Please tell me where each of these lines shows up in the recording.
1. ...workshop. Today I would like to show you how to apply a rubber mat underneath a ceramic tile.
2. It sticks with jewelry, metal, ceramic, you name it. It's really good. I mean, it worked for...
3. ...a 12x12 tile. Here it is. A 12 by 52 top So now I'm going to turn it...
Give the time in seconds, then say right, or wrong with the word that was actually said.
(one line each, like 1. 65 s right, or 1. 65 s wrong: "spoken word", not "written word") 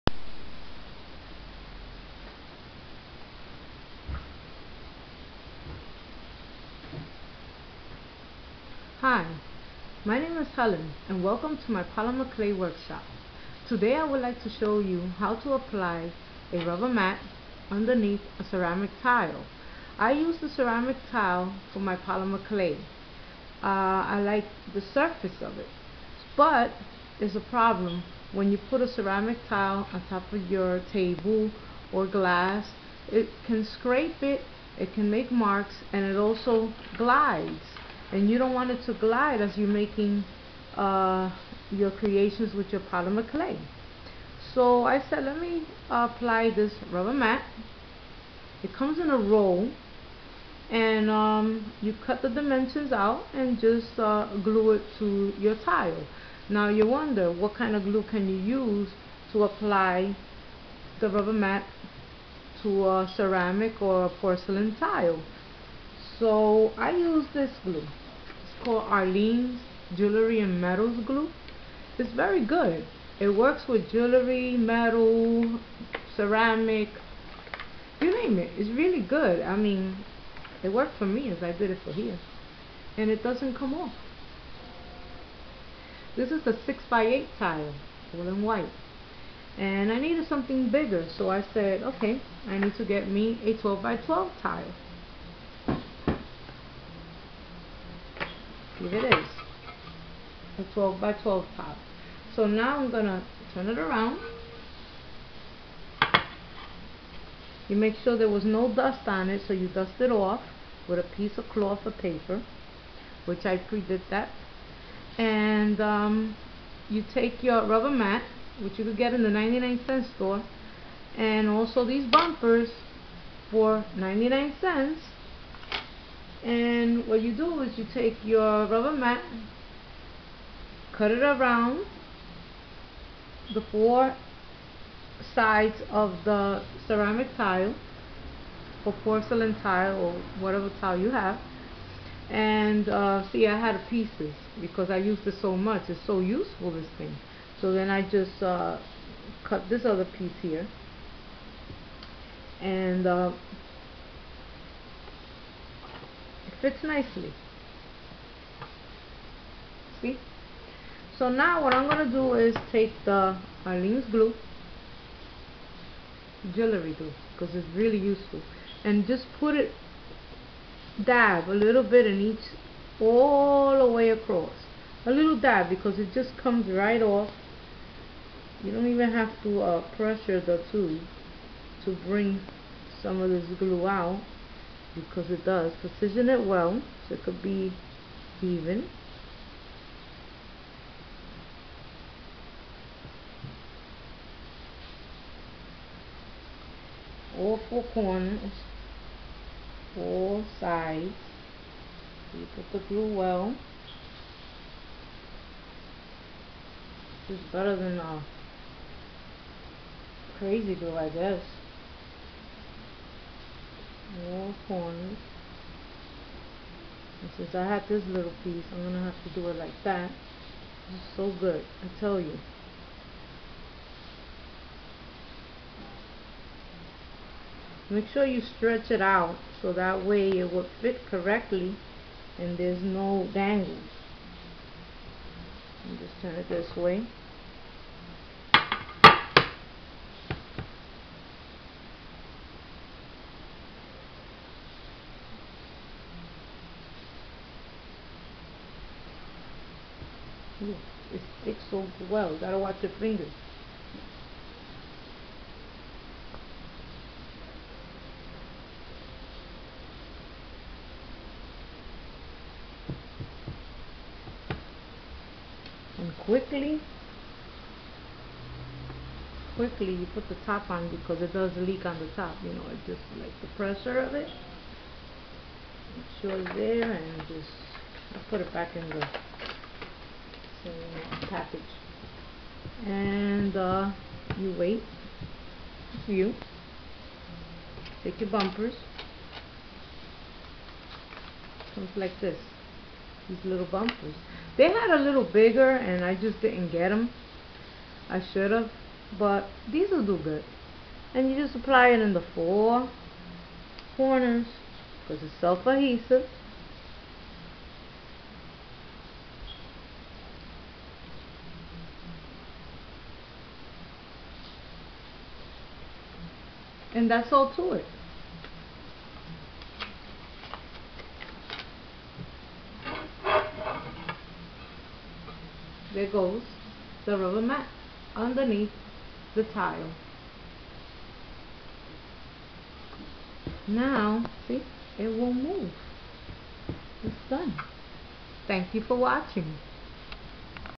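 1. 12 s right
2. 73 s wrong: "works", not "sticks"
3. 93 s wrong: "12", not "52".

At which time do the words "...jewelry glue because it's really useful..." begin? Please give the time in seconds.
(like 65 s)
166 s.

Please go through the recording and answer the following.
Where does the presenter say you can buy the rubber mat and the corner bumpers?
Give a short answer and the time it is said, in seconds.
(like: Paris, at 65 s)
99 cent store, at 119 s.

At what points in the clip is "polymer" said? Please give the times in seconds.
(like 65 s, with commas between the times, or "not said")
11 s, 21 s, 42 s.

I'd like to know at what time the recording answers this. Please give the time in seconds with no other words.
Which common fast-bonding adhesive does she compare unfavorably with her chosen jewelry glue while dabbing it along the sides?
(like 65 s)
210 s.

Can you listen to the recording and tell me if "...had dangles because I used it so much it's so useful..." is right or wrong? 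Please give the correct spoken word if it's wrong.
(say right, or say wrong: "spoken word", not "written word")
wrong: "pieces", not "dangles".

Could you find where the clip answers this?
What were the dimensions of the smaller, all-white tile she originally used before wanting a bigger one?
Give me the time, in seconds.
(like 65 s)
86 s.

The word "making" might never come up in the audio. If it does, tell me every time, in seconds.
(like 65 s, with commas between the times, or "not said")
39 s.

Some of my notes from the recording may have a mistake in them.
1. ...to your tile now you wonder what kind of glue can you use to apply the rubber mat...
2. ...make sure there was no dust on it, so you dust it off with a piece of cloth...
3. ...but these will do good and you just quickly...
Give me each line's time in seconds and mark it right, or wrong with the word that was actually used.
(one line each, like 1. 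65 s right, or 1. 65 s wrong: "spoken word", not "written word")
1. 54 s right
2. 107 s right
3. 299 s wrong: "apply", not "quickly".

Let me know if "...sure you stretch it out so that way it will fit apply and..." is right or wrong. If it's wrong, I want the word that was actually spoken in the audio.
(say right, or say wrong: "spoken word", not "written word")
wrong: "correctly", not "apply".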